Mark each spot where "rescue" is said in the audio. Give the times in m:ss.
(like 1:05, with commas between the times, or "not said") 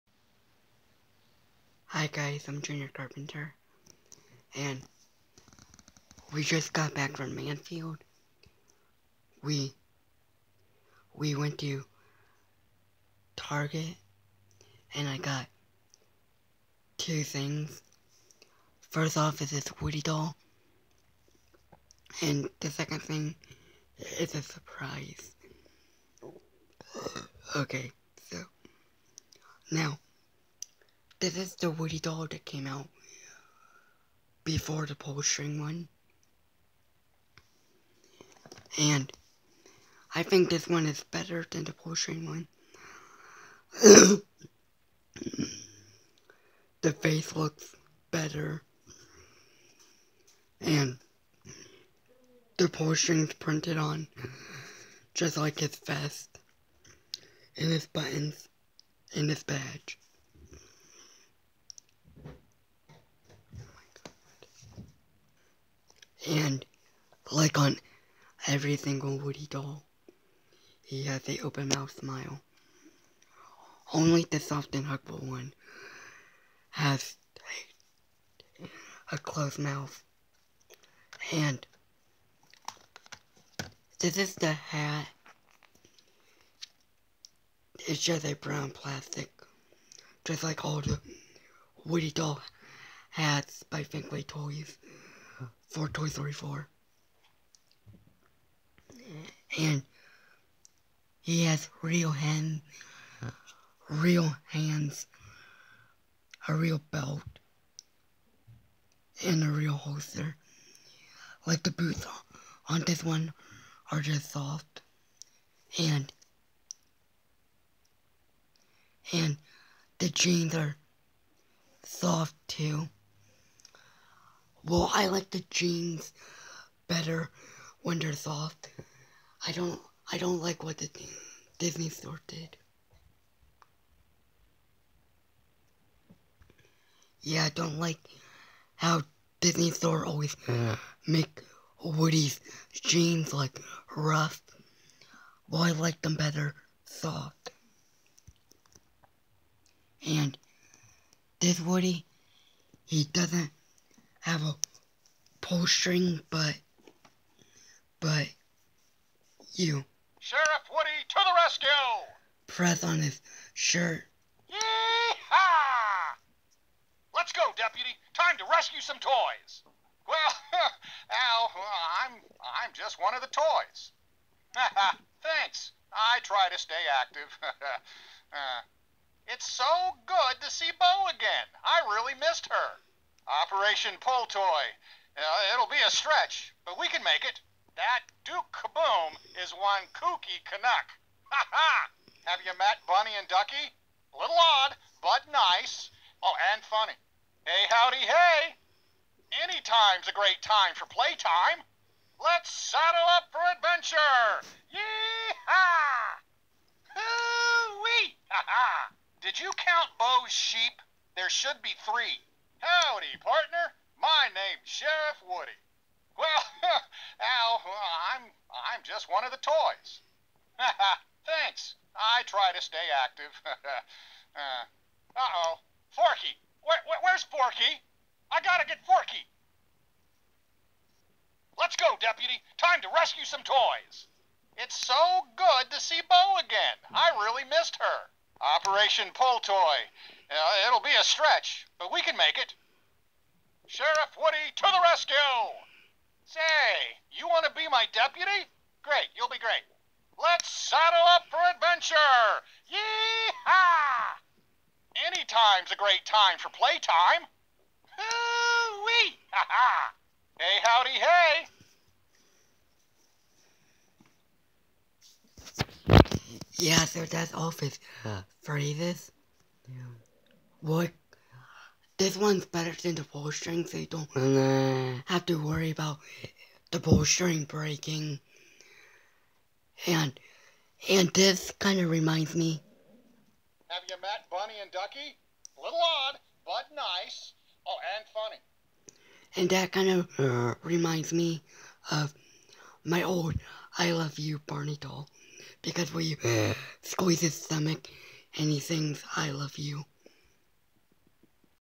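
2:41, 2:48, 3:52, 4:04.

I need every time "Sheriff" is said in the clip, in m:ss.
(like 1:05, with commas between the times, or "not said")
2:40, 3:34, 4:03.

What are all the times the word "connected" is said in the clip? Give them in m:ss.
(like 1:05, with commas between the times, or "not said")
not said.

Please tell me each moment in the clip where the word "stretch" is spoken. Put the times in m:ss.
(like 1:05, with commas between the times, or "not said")
3:05, 4:01.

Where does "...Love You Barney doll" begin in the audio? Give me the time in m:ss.
4:53.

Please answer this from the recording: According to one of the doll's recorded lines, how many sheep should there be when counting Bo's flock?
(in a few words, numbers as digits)
3.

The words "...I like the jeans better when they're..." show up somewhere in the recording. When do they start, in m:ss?
2:04.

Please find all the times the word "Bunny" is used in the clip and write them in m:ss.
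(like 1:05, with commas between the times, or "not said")
3:12, 4:44.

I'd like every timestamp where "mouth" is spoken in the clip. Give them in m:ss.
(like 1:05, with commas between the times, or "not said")
1:11, 1:19.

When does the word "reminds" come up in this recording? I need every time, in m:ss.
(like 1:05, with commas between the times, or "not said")
4:41, 4:50.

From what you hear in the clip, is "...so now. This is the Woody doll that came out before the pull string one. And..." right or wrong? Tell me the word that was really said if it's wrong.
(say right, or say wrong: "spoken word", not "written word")
right.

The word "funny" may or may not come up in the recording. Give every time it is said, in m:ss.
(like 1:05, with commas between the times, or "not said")
3:16, 4:48.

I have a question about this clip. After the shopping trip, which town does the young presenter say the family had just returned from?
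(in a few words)
Manfield.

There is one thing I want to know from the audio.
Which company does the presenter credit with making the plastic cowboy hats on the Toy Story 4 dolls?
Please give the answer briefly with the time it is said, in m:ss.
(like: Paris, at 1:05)
Thinkway Toys, at 1:33.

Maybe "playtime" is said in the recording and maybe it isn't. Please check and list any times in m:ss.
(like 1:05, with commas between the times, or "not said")
3:20, 4:16.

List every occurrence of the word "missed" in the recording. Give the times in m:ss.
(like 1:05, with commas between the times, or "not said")
3:02, 3:57.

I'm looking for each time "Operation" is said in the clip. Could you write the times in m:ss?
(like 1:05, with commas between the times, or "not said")
3:03, 3:58.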